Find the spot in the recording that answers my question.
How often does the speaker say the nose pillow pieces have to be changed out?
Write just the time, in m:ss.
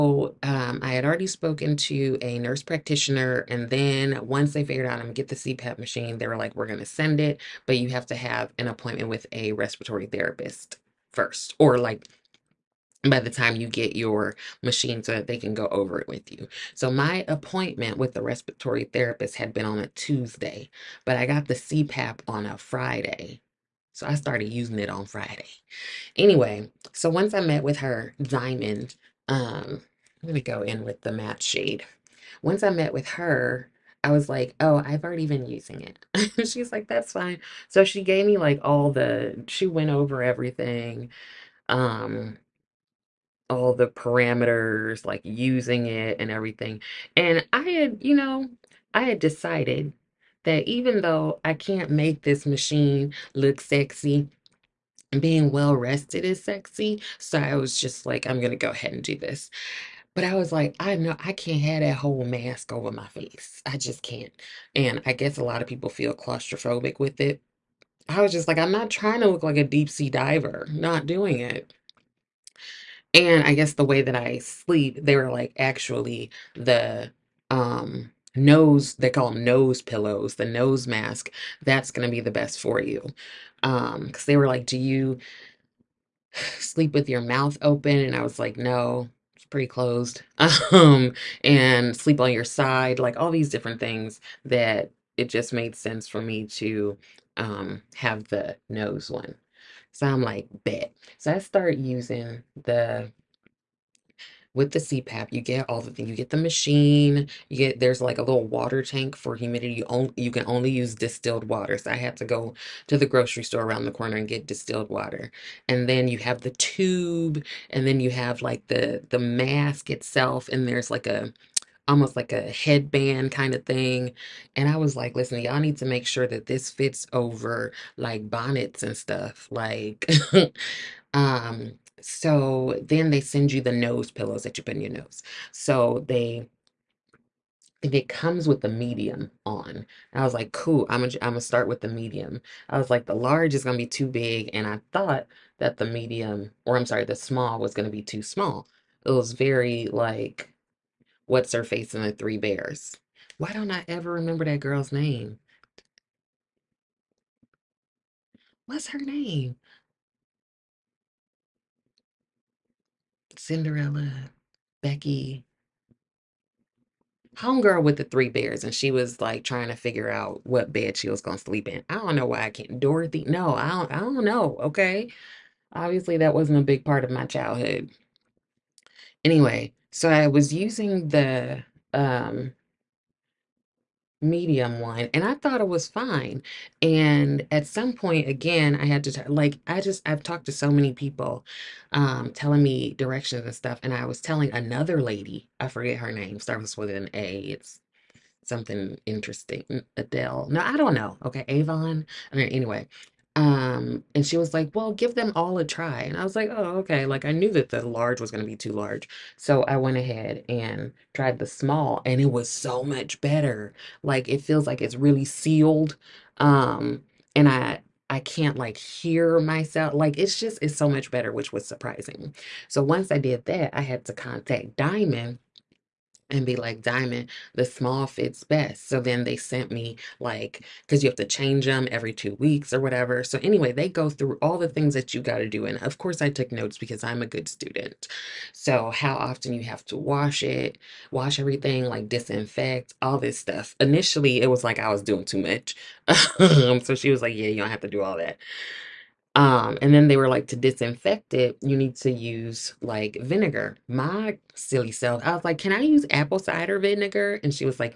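3:51.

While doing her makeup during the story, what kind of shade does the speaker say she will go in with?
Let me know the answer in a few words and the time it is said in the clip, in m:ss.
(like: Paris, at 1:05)
matte shade, at 0:31.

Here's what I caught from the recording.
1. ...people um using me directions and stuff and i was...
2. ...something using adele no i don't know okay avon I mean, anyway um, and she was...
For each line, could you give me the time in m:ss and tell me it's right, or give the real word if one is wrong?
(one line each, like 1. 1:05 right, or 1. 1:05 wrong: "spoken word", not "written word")
1. 3:10 wrong: "telling", not "using"
2. 3:18 wrong: "interesting", not "using".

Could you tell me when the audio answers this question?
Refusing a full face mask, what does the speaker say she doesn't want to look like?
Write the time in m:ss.
1:09.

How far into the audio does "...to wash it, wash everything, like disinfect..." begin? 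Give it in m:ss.
3:59.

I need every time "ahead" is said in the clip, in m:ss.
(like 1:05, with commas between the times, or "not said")
0:58, 3:29.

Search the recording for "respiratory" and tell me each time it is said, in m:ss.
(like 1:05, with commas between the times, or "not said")
0:09, 0:18.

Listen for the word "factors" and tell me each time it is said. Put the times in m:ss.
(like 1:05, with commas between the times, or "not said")
not said.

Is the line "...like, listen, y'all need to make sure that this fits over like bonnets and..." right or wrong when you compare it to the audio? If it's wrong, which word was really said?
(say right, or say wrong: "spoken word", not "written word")
right.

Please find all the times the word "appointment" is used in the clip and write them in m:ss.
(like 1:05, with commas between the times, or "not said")
0:08, 0:17.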